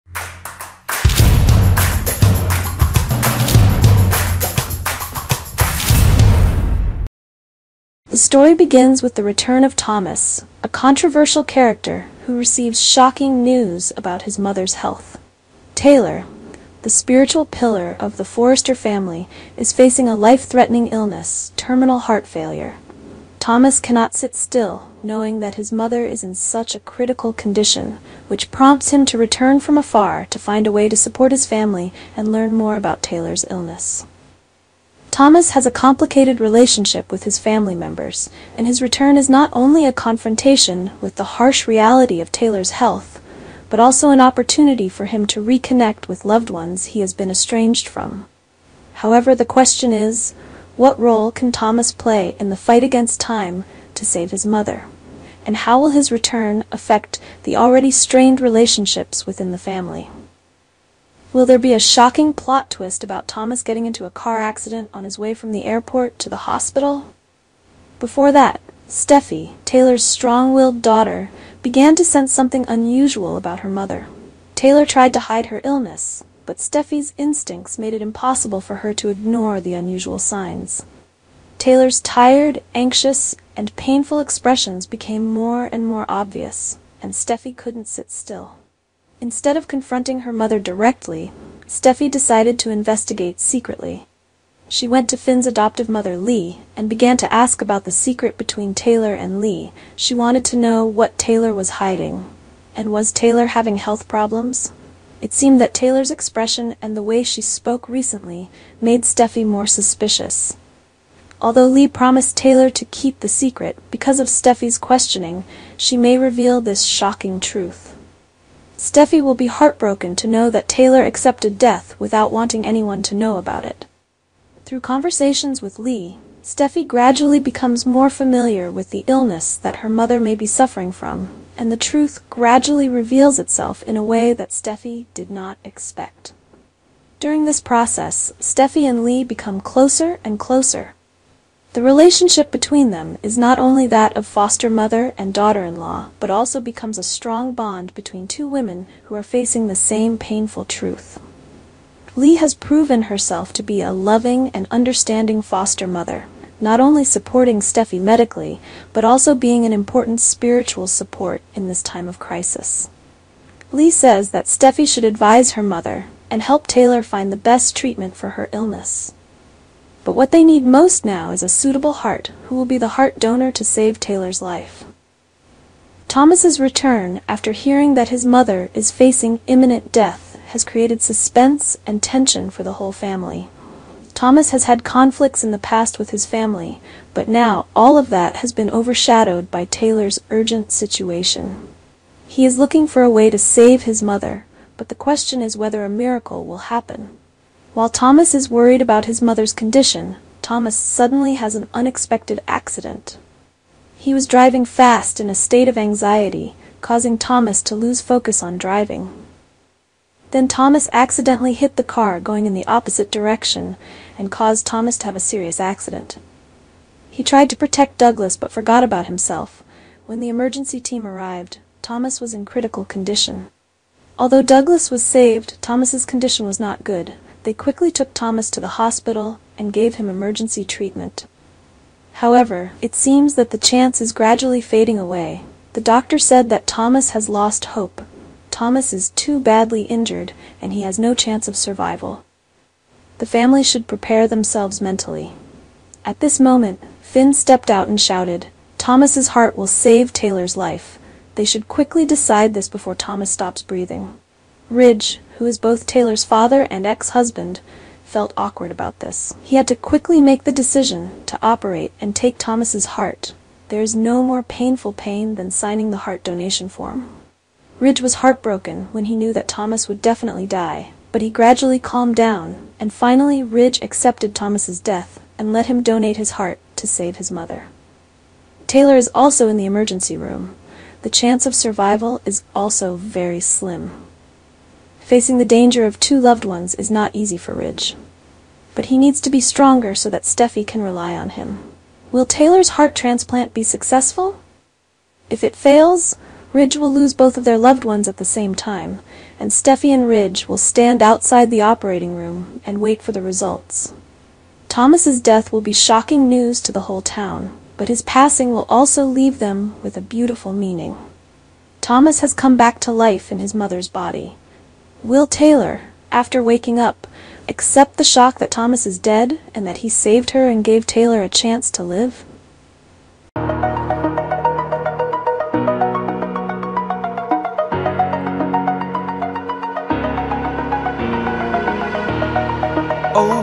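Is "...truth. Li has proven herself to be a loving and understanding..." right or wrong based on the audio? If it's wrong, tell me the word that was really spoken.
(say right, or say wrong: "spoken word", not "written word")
right.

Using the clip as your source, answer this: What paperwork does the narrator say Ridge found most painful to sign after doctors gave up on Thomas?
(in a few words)
heart donation form.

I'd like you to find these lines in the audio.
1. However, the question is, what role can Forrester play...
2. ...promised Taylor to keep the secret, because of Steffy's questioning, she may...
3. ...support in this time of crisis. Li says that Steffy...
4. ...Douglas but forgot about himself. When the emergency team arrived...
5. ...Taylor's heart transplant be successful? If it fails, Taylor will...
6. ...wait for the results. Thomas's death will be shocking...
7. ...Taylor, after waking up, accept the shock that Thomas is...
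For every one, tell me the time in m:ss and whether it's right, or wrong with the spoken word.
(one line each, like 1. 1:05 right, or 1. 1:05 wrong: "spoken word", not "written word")
1. 0:49 wrong: "Thomas", not "Forrester"
2. 1:51 right
3. 2:40 right
4. 3:37 right
5. 4:52 wrong: "Ridge", not "Taylor"
6. 5:02 right
7. 5:15 right.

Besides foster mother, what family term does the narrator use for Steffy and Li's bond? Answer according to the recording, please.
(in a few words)
daughter-in-law.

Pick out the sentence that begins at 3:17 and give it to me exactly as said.
While Thomas is worried about his mother's condition, Thomas suddenly has an unexpected accident.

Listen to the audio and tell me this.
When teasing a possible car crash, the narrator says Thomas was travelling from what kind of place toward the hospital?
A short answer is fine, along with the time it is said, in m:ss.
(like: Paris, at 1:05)
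the airport, at 1:05.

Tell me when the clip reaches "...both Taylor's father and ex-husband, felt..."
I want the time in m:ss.
4:15.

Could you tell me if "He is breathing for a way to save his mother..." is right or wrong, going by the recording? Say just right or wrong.
wrong.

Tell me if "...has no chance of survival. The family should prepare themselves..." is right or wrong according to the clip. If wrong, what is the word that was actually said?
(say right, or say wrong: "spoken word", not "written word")
right.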